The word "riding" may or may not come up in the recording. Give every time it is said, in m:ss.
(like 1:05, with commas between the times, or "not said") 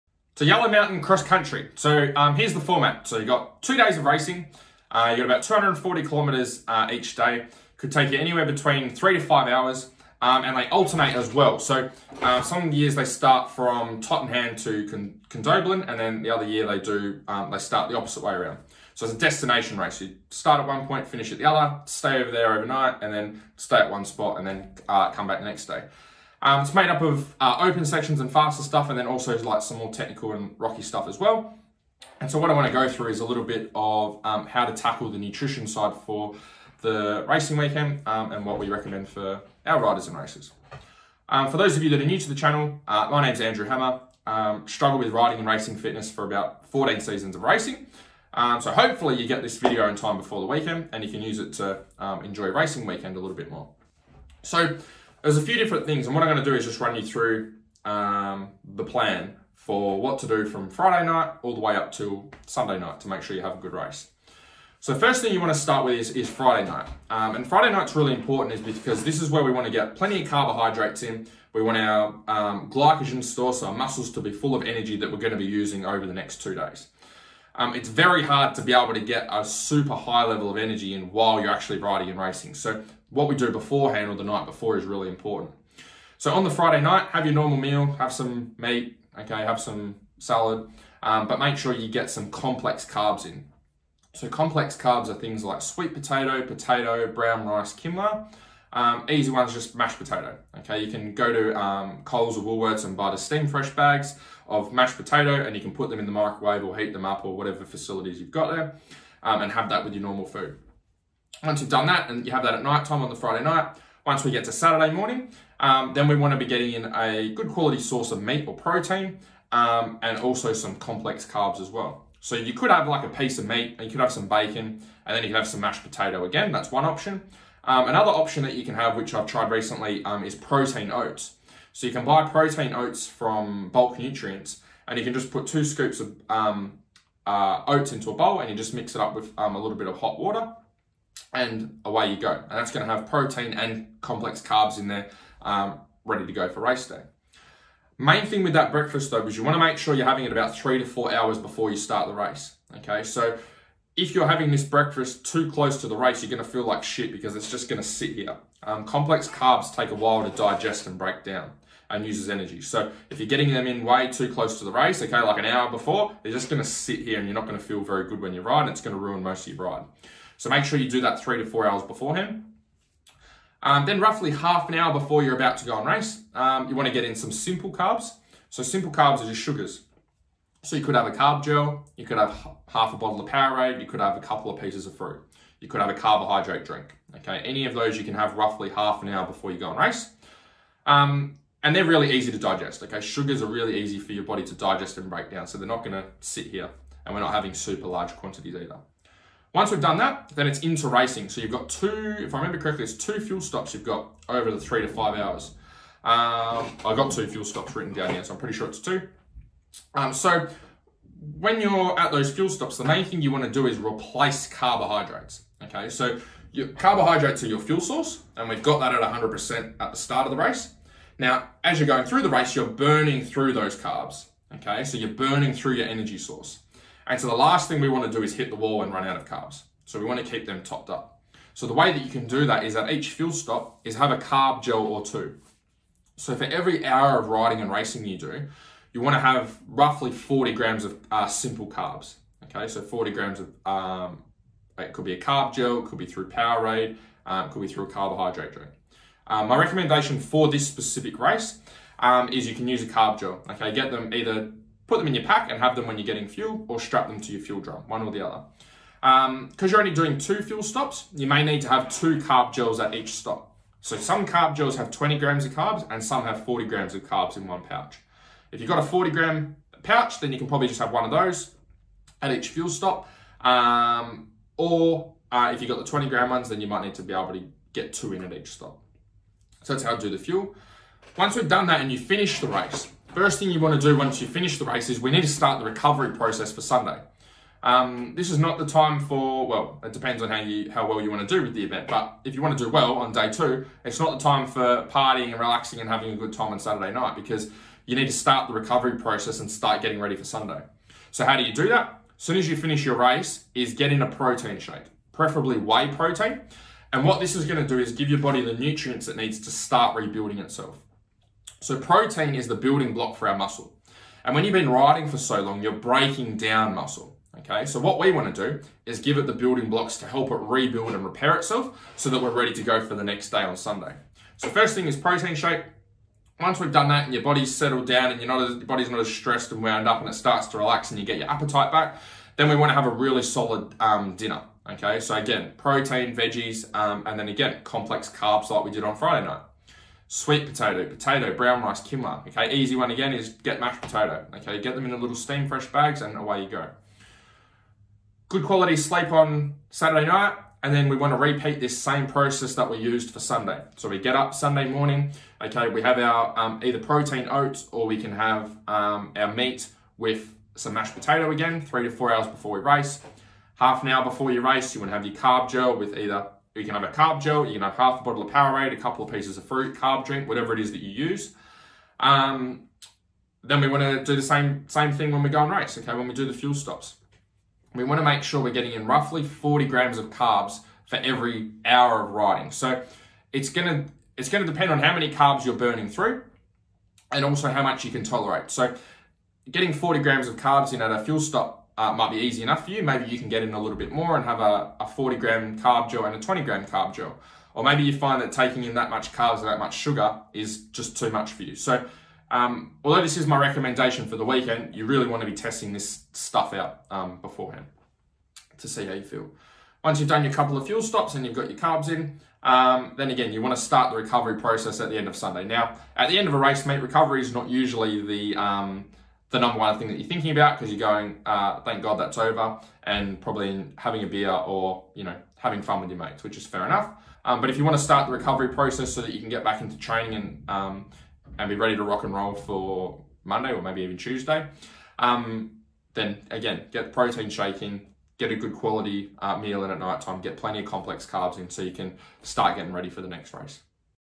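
0:45, 1:21, 3:57, 5:14, 6:22.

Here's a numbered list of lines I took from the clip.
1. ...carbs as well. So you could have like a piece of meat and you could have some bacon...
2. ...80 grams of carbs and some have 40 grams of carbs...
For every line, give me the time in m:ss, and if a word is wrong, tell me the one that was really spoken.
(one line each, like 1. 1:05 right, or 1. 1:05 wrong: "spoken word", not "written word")
1. 2:01 right
2. 4:24 wrong: "20", not "80".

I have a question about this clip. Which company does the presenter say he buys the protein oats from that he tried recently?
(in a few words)
Bulk Nutrients.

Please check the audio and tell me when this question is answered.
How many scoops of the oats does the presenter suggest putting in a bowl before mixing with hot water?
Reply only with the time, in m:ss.
2:15.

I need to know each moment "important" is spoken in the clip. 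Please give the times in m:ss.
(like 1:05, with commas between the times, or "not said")
1:08, 1:25.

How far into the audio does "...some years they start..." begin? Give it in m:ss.
0:12.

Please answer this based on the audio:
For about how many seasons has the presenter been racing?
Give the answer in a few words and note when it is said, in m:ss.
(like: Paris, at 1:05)
14, at 0:46.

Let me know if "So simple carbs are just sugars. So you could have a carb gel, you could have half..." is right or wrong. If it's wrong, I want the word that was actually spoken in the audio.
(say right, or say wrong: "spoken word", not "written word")
right.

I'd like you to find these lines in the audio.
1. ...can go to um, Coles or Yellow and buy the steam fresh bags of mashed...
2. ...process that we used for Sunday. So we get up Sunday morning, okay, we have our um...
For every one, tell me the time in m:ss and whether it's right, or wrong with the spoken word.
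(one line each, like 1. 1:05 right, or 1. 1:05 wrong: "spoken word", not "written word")
1. 1:40 wrong: "Woolworths", not "Yellow"
2. 5:52 right.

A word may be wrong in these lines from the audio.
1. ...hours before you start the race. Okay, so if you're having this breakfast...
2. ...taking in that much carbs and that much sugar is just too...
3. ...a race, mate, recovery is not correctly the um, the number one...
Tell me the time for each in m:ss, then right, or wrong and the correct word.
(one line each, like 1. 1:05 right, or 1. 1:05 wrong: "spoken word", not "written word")
1. 2:31 right
2. 6:38 right
3. 6:56 wrong: "usually", not "correctly".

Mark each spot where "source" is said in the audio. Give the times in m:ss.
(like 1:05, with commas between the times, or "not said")
1:57, 3:37, 3:46.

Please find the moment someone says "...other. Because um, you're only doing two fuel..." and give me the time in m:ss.
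4:18.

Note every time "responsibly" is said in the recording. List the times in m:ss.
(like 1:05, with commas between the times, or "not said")
not said.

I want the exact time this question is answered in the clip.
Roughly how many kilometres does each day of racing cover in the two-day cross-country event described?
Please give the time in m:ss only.
0:05.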